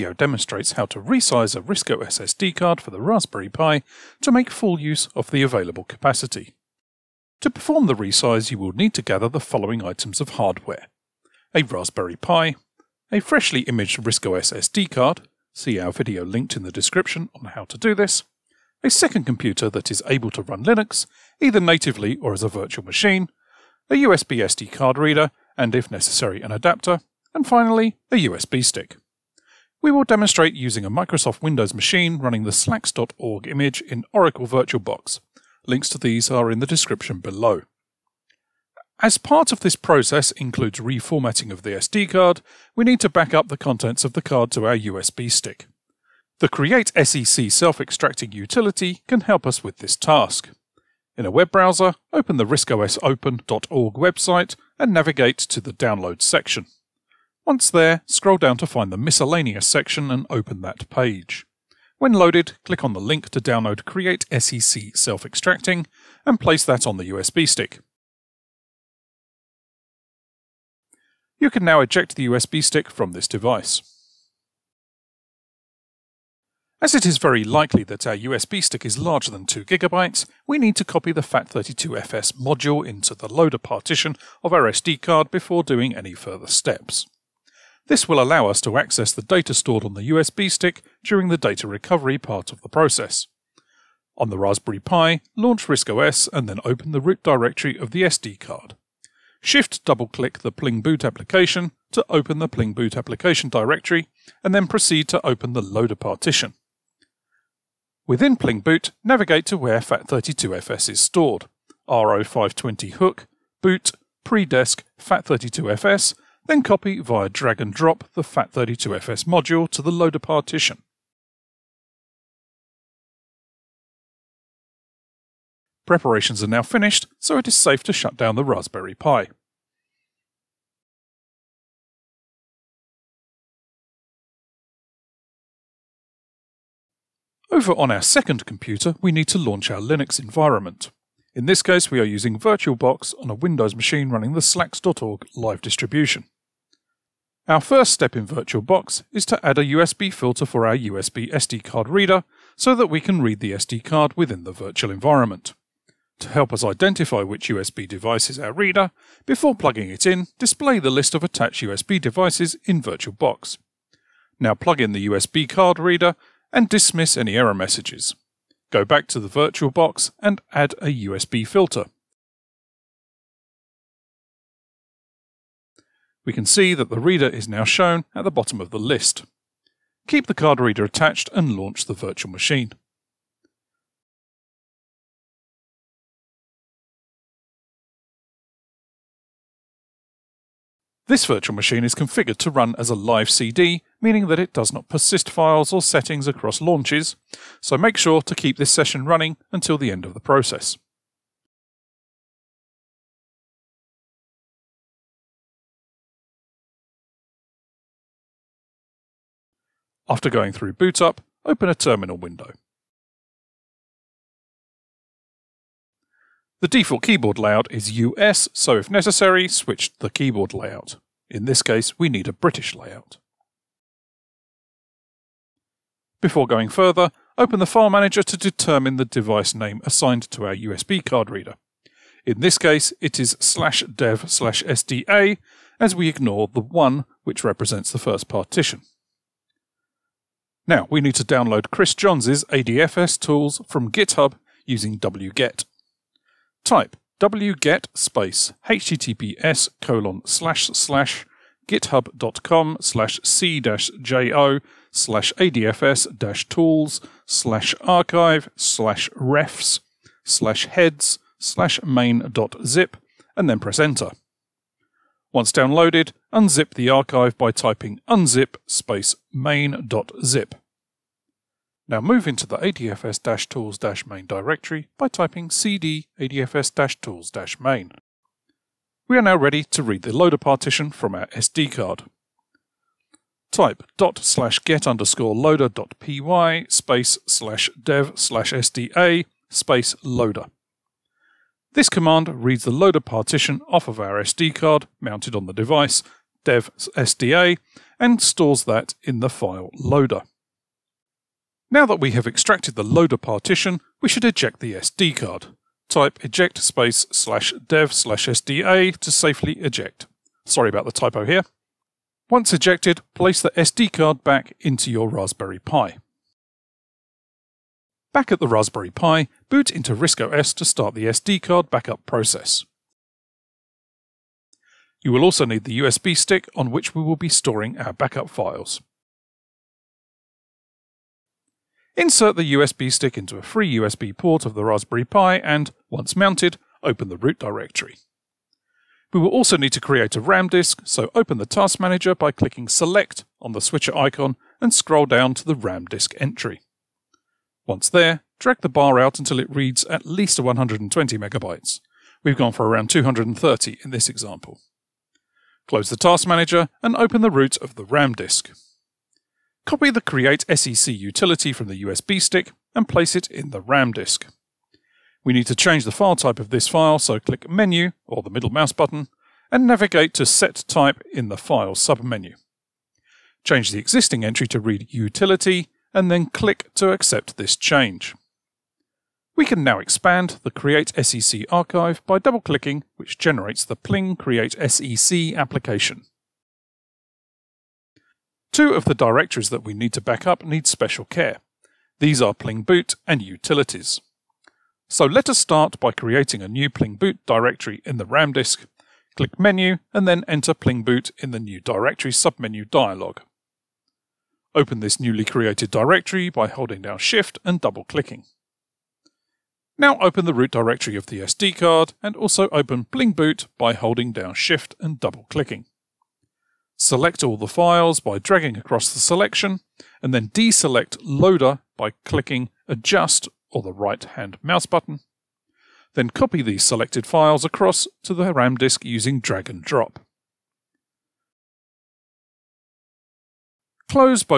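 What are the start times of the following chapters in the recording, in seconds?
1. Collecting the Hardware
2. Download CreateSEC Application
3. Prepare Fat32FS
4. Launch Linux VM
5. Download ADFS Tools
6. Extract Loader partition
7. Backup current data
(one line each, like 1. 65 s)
1. 6 s
2. 39 s
3. 77 s
4. 138 s
5. 237 s
6. 278 s
7. 316 s.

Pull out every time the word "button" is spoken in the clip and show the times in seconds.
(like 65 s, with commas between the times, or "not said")
368 s, 424 s.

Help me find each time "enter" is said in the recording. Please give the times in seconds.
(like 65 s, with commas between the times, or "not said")
263 s, 400 s.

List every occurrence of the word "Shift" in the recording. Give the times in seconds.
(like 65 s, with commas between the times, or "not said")
99 s, 406 s, 414 s.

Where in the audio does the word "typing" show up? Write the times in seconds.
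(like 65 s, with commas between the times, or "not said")
267 s, 275 s.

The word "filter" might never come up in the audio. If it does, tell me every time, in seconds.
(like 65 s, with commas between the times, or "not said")
150 s, 171 s.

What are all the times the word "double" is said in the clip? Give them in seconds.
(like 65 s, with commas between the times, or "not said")
99 s, 382 s, 407 s, 414 s.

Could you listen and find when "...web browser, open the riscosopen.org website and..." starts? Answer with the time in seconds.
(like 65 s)
51 s.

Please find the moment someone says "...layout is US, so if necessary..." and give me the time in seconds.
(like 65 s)
217 s.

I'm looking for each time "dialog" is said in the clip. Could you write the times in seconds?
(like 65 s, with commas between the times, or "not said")
402 s.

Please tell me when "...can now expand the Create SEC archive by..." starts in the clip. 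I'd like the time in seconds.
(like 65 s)
379 s.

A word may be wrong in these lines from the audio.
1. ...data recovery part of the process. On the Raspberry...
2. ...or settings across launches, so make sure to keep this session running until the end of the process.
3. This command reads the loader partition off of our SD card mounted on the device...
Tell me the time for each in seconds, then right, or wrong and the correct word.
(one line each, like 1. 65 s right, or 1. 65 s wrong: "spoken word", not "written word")
1. 91 s right
2. 195 s right
3. 291 s right.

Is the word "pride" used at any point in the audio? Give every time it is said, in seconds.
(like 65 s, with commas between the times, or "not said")
not said.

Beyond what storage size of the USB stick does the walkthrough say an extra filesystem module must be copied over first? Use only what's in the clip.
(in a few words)
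2GB.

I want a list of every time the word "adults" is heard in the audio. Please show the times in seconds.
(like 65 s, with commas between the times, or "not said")
not said.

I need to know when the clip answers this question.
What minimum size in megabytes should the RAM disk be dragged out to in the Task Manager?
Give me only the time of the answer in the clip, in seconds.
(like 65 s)
350 s.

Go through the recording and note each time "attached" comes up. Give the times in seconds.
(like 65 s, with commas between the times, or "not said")
161 s, 180 s.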